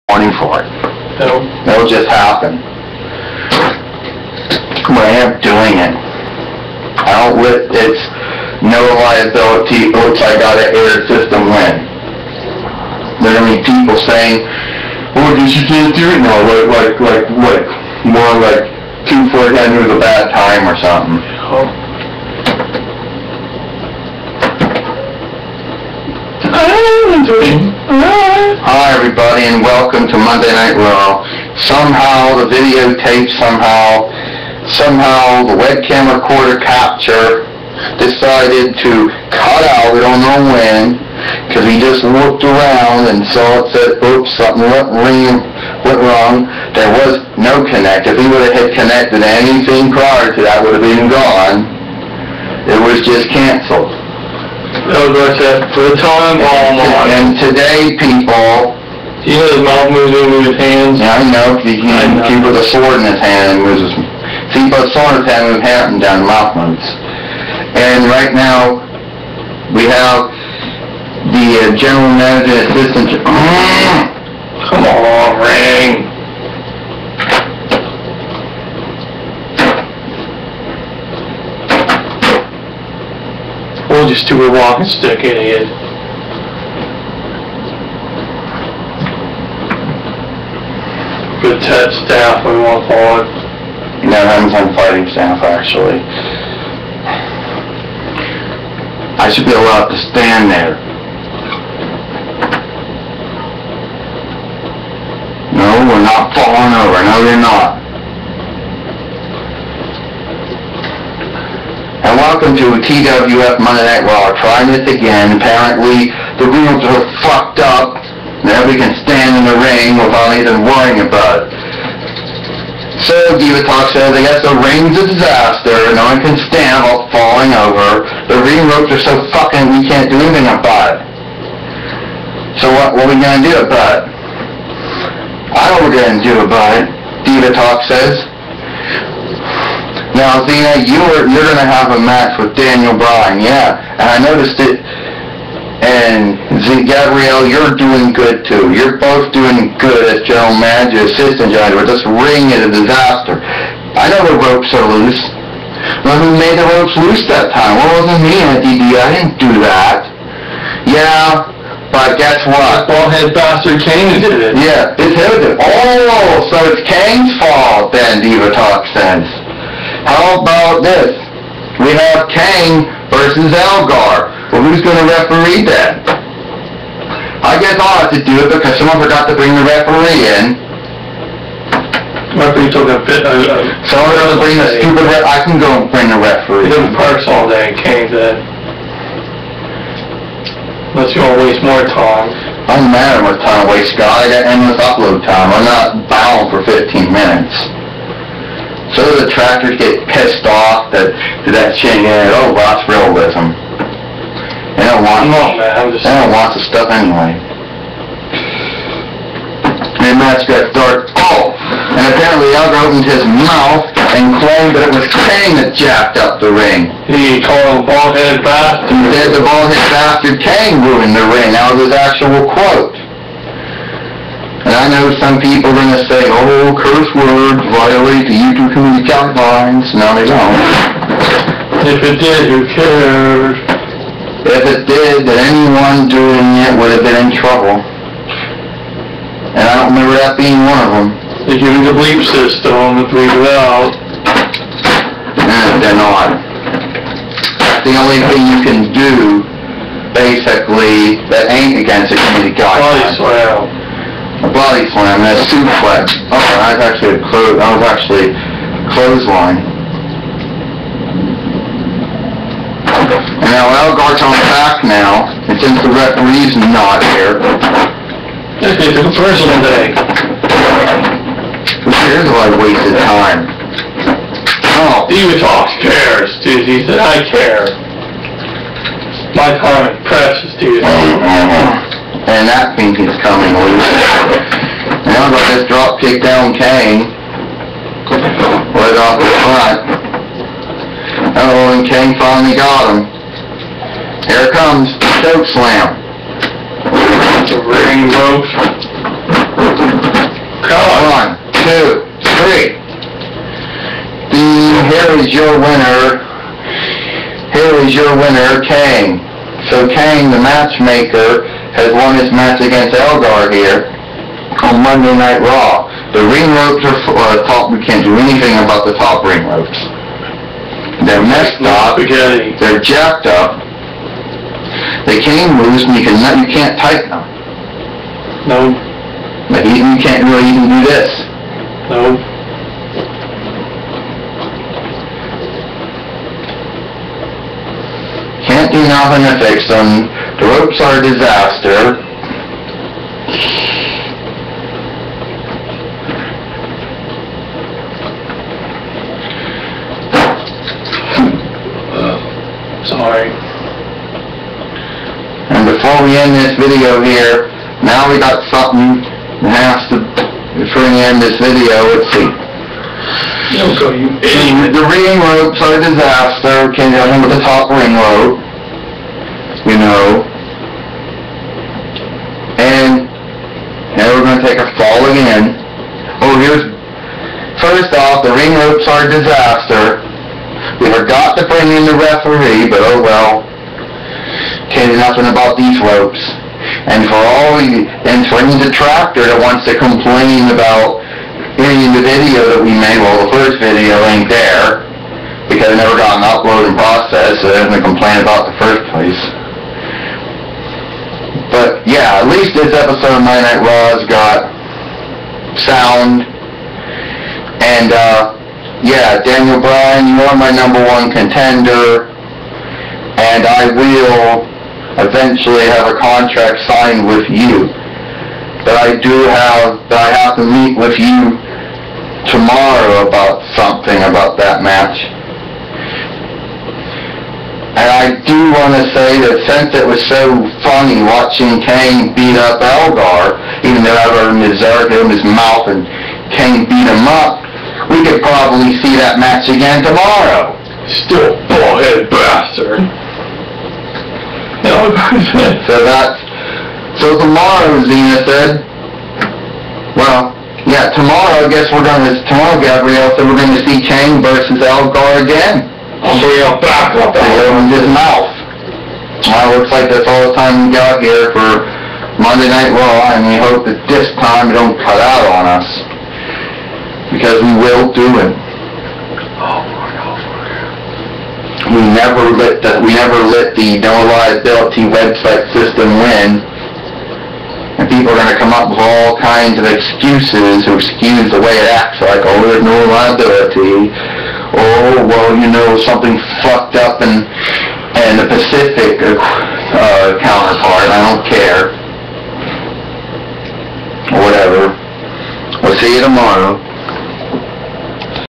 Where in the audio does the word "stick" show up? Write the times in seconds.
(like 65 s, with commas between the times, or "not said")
84 s.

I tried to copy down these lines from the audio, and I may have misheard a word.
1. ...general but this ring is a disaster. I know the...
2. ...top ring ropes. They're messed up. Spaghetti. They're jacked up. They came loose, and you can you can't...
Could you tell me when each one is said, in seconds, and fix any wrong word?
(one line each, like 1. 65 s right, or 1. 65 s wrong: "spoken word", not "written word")
1. 151 s right
2. 318 s right.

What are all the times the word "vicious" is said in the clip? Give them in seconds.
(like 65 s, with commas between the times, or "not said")
not said.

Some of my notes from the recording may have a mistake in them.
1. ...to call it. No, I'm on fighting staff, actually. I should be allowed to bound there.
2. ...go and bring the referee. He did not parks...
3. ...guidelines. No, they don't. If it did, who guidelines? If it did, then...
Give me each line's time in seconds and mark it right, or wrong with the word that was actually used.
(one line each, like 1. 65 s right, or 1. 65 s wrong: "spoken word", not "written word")
1. 92 s wrong: "stand", not "bound"
2. 185 s right
3. 229 s wrong: "cares", not "guidelines".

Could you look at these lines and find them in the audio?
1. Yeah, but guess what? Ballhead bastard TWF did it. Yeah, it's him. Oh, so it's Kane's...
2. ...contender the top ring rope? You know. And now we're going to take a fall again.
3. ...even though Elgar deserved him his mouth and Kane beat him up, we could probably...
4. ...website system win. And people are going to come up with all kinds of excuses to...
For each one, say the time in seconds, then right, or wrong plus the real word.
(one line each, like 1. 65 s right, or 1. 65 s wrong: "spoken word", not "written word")
1. 160 s wrong: "Kane", not "TWF"
2. 367 s wrong: "remember", not "contender"
3. 433 s right
4. 474 s right.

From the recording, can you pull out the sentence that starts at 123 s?
So Diva Talk says, I guess the ring's a disaster.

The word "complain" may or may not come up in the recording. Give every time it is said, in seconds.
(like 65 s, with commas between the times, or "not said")
389 s, 397 s.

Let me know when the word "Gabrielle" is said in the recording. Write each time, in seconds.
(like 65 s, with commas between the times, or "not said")
146 s, 452 s.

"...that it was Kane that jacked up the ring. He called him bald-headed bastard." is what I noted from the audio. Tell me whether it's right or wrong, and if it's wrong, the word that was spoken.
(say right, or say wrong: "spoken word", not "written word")
right.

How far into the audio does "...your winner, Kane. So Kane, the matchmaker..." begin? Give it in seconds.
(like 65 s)
307 s.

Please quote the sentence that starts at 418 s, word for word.
But I do have, that I have to meet with you tomorrow about something about that match.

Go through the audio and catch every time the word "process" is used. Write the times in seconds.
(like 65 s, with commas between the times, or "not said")
396 s.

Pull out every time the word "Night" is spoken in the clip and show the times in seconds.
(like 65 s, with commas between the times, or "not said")
30 s, 113 s, 315 s, 403 s, 462 s.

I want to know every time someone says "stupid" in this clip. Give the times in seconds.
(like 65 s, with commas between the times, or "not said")
84 s, 184 s.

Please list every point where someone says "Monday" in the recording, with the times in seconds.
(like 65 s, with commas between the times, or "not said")
30 s, 113 s, 314 s, 462 s.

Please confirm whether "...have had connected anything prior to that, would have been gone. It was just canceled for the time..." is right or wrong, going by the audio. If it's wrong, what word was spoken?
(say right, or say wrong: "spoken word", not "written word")
right.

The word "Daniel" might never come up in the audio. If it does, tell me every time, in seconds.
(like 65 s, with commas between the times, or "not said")
142 s, 409 s.